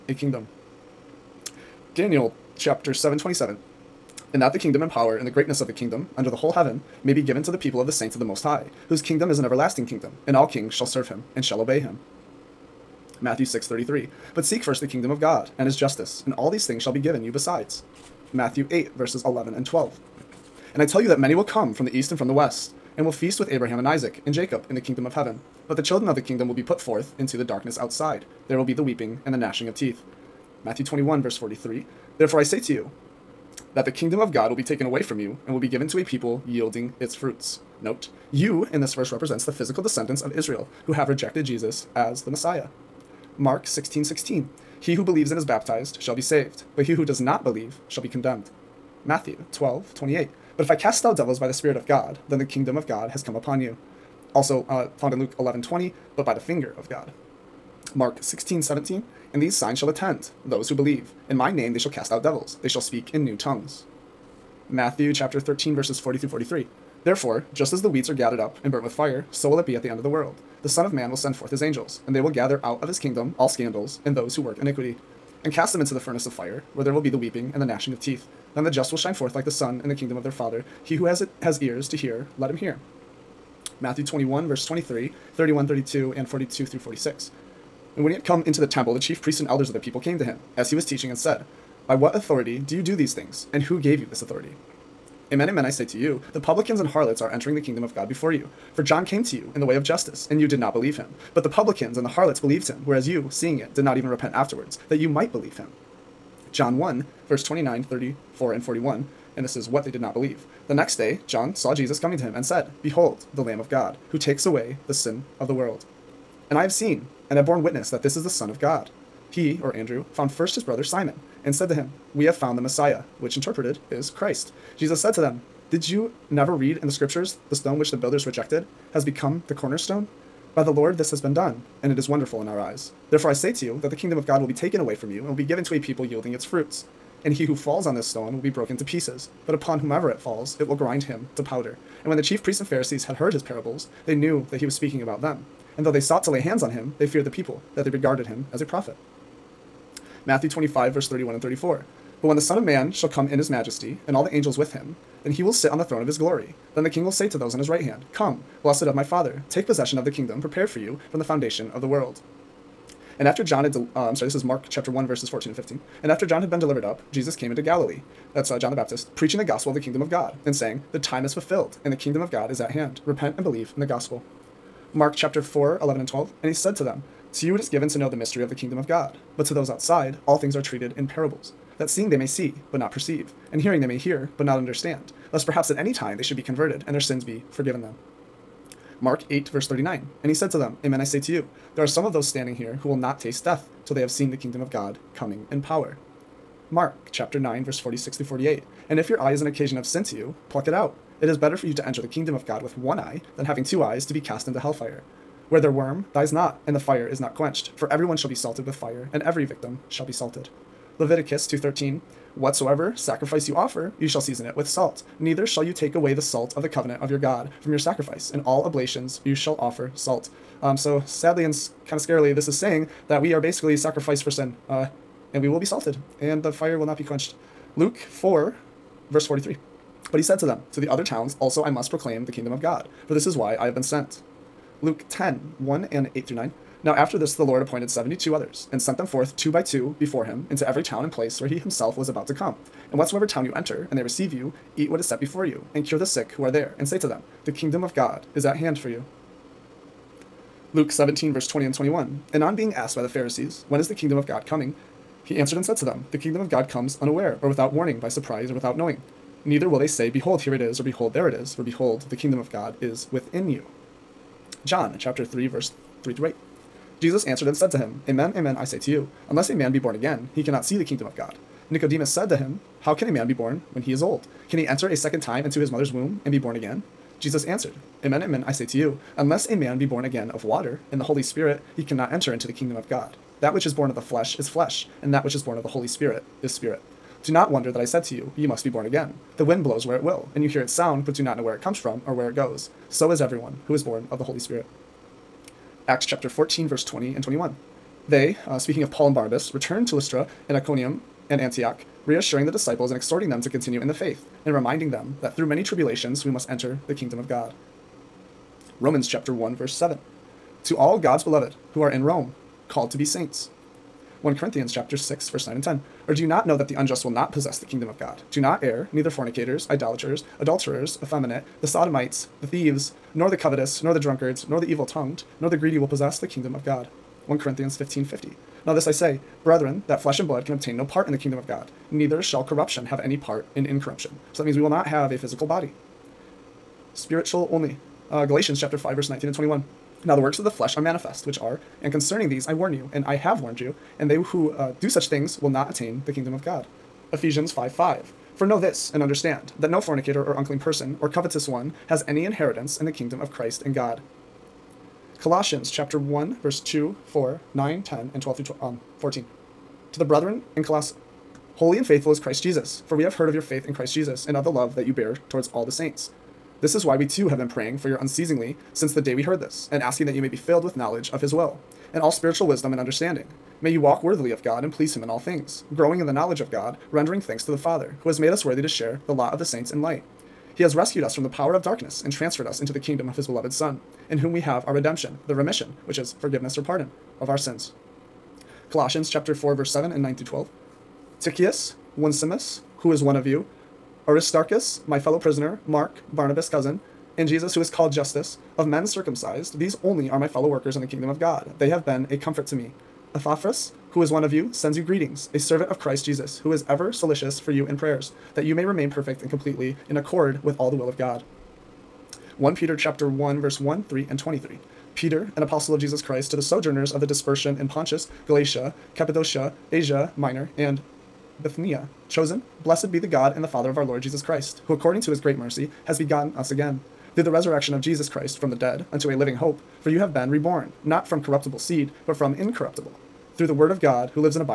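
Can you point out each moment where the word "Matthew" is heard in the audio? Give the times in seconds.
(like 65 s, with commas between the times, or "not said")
13 s, 18 s, 30 s, 49 s, 64 s, 83 s, 150 s.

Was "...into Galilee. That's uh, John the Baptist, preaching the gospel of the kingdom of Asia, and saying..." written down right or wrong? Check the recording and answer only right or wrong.
wrong.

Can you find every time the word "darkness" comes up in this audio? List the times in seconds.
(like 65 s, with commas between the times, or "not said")
27 s, 381 s.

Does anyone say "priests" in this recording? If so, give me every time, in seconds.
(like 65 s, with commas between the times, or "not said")
89 s, 142 s.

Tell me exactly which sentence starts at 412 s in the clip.
1 Peter chapter 1 verse 1, 3 and 23.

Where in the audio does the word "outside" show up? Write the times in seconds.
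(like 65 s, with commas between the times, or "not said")
27 s, 179 s.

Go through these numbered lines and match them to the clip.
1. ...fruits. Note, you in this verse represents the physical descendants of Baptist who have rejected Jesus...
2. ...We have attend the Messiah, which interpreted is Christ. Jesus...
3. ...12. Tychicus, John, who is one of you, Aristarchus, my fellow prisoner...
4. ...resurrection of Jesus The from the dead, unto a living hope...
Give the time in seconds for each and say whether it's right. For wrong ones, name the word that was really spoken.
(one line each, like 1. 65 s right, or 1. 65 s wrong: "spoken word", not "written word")
1. 37 s wrong: "Israel", not "Baptist"
2. 122 s wrong: "found", not "attend"
3. 390 s wrong: "Onesimus", not "John"
4. 427 s wrong: "Christ", not "The".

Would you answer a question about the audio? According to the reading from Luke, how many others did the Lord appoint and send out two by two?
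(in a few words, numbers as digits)
72.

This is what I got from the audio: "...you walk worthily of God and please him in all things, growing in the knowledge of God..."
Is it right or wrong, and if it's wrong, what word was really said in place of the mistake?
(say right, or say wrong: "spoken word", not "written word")
right.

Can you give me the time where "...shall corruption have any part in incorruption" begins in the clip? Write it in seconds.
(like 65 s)
332 s.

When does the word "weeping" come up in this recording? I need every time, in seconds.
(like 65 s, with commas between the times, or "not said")
28 s, 77 s.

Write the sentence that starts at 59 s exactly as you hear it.
And these signs shall attend those who believe.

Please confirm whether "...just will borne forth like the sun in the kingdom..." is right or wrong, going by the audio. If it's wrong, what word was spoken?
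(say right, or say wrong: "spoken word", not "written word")
wrong: "shine", not "borne".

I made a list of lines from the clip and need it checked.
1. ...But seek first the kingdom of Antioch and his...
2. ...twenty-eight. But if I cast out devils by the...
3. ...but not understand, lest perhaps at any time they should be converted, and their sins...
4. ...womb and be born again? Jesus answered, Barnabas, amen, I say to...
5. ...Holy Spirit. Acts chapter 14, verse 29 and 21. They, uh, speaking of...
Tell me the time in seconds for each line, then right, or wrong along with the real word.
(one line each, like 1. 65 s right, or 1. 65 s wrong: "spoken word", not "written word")
1. 14 s wrong: "God", not "Antioch"
2. 49 s right
3. 184 s right
4. 275 s wrong: "Amen", not "Barnabas"
5. 294 s wrong: "20", not "29".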